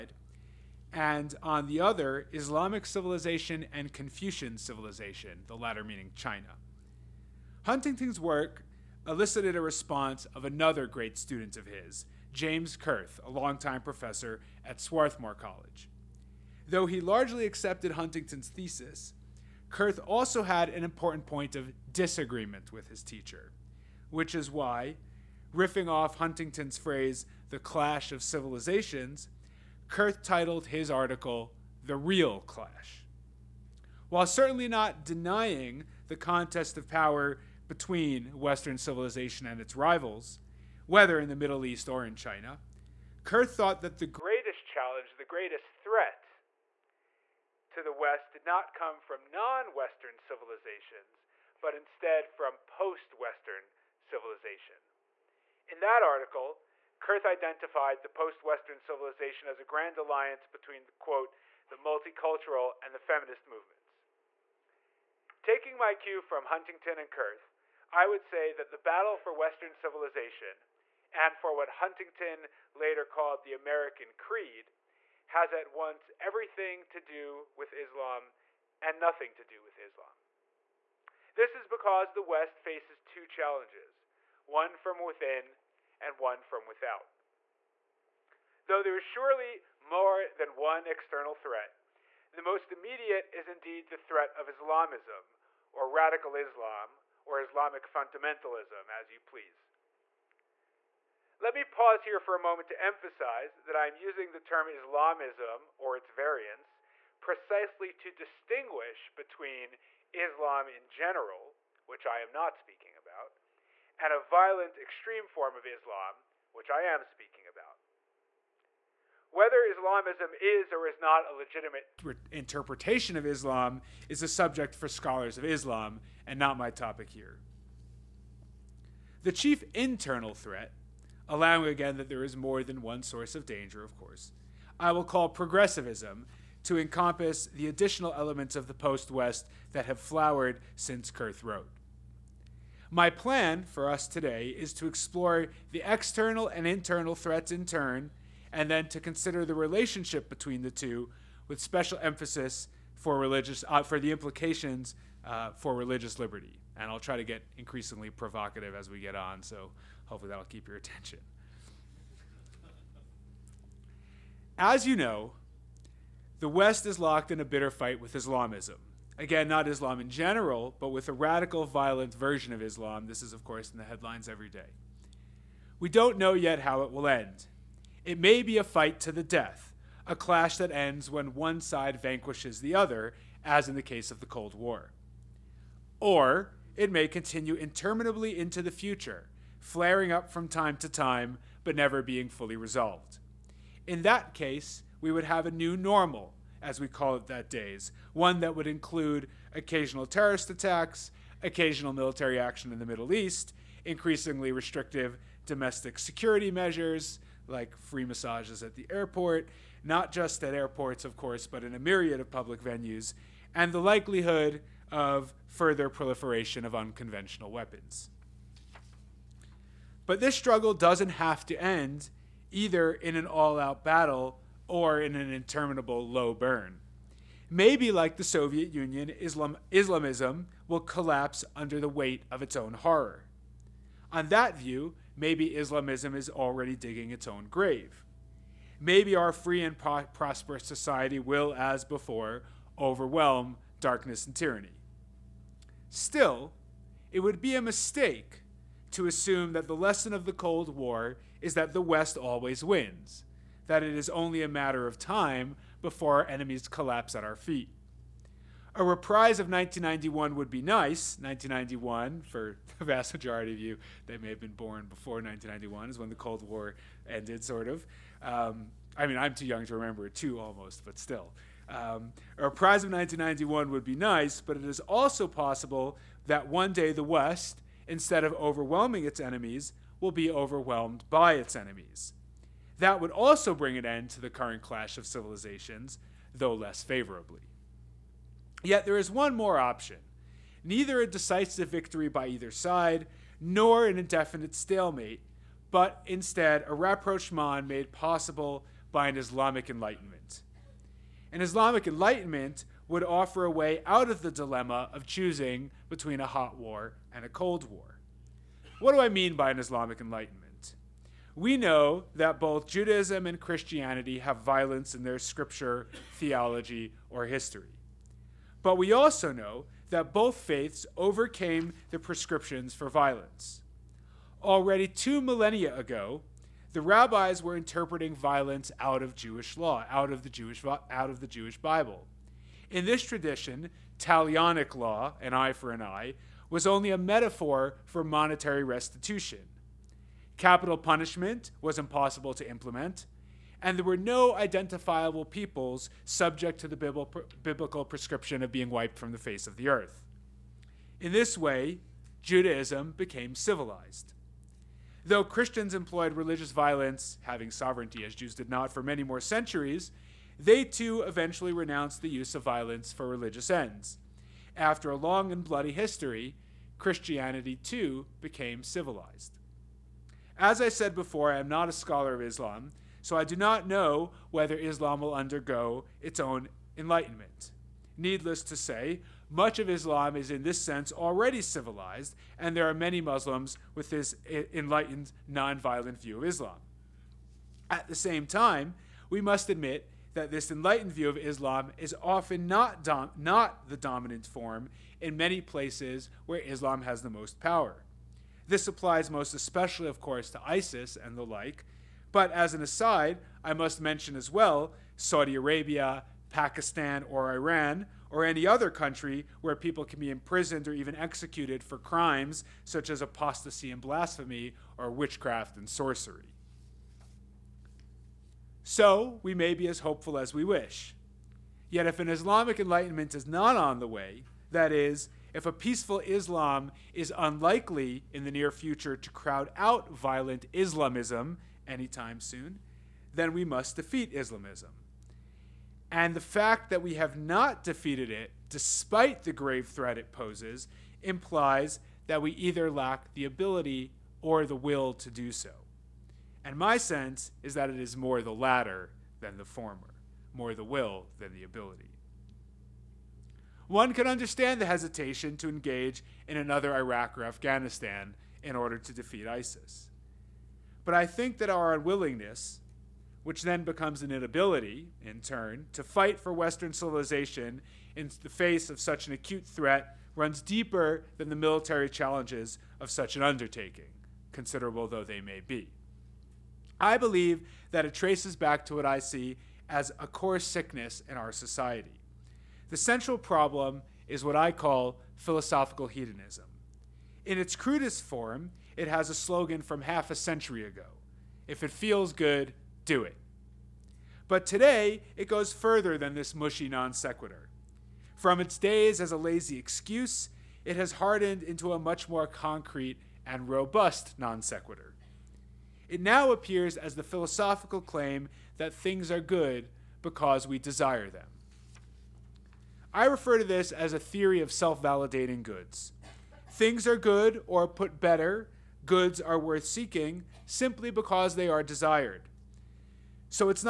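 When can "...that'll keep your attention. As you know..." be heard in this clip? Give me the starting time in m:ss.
2:40.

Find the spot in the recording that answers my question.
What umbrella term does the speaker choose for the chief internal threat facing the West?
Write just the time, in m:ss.
2:15.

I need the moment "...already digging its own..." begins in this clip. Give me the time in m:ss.
3:56.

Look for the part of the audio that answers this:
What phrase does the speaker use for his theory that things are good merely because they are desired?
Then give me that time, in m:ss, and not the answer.
8:34.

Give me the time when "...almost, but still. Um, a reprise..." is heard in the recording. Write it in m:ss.
4:30.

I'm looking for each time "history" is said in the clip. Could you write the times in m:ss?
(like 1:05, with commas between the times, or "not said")
5:17, 6:05.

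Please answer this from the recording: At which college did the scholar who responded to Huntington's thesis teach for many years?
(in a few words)
Swarthmore College.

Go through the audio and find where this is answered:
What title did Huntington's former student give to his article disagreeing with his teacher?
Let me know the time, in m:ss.
0:31.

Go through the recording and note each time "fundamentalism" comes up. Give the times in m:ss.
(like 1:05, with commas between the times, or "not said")
1:37.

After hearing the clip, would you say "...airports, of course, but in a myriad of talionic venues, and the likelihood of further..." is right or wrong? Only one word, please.
wrong.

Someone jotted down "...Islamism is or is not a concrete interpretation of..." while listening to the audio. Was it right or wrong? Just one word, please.
wrong.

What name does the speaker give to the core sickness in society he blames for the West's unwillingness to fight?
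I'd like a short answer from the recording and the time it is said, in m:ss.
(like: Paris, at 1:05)
philosophical hedonism, at 8:05.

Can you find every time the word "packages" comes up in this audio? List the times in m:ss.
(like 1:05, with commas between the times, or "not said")
not said.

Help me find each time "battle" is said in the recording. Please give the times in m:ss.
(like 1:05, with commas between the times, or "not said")
1:08, 3:43.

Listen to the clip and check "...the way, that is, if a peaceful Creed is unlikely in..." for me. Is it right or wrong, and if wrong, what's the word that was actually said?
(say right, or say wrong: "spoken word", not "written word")
wrong: "Islam", not "Creed".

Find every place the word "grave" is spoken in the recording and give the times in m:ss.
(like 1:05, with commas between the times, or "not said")
3:57, 7:19.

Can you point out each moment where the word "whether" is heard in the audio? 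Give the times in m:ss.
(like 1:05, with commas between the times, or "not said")
0:40, 1:59, 6:14.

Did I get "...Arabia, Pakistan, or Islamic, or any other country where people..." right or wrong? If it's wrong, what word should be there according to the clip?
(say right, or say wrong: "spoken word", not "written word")
wrong: "Iran", not "Islamic".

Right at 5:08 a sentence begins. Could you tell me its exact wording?
What do I mean by an Islamic Enlightenment?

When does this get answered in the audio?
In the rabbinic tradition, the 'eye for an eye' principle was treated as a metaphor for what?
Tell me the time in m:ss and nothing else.
5:38.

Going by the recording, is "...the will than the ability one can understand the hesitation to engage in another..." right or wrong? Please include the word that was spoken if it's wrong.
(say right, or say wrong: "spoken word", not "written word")
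right.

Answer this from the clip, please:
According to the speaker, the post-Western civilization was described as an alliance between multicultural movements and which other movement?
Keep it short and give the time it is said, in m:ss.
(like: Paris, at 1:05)
feminist movements, at 1:02.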